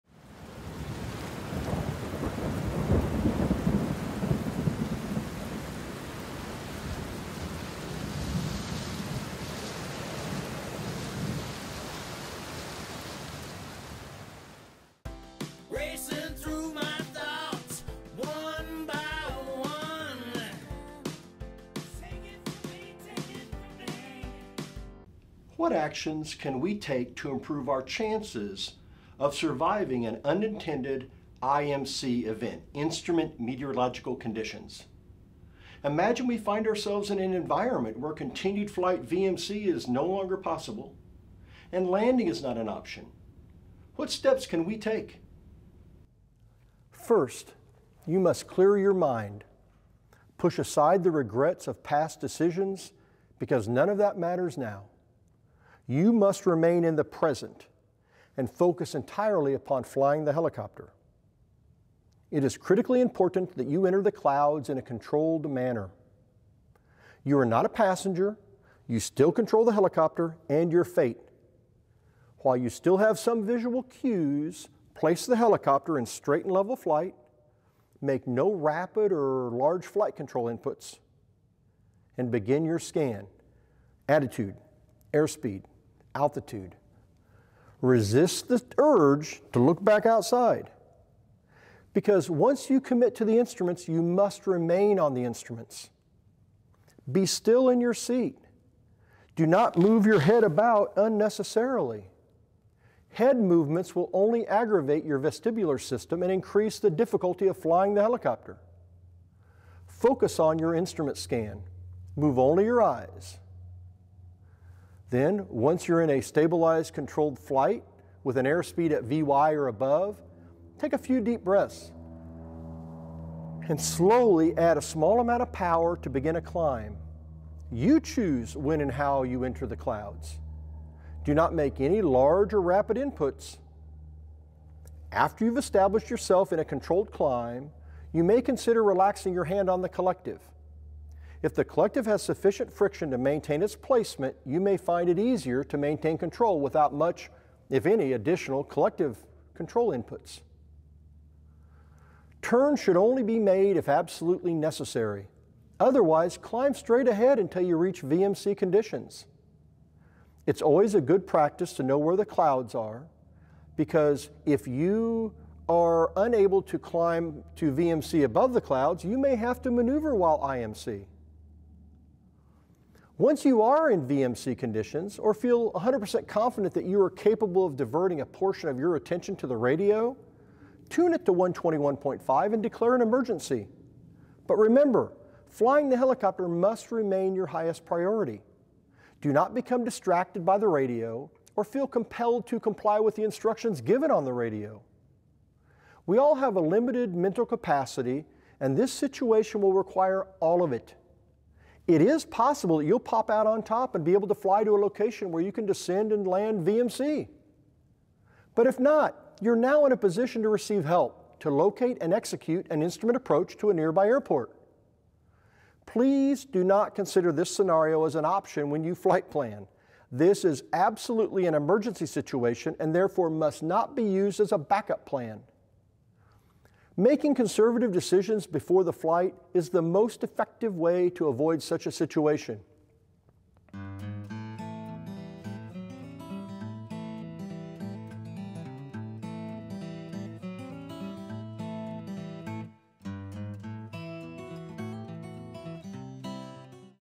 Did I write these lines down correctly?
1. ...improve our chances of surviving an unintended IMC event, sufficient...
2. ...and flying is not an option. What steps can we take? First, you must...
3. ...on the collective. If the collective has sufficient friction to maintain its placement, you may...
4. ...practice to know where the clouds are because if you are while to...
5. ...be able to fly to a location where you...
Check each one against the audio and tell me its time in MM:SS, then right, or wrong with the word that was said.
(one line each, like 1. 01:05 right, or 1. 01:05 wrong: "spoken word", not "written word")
1. 00:27 wrong: "instrument", not "sufficient"
2. 00:41 wrong: "landing", not "flying"
3. 02:19 right
4. 02:41 wrong: "unable", not "while"
5. 03:24 right.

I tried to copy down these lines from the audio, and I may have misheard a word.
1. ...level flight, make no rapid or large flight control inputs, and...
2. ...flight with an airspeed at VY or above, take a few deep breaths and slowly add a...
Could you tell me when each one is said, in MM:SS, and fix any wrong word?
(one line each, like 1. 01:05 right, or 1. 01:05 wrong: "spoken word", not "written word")
1. 01:16 right
2. 01:57 right.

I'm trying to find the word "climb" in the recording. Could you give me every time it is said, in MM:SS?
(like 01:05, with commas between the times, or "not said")
02:06, 02:17, 02:36, 02:46.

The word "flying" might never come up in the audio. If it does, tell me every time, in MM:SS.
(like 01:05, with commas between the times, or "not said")
00:59, 01:47, 03:05.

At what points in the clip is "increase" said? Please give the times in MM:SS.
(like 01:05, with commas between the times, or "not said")
01:46.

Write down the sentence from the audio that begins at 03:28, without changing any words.
But if not, you're now in a position to receive help to locate and execute an instrument approach to a nearby airport.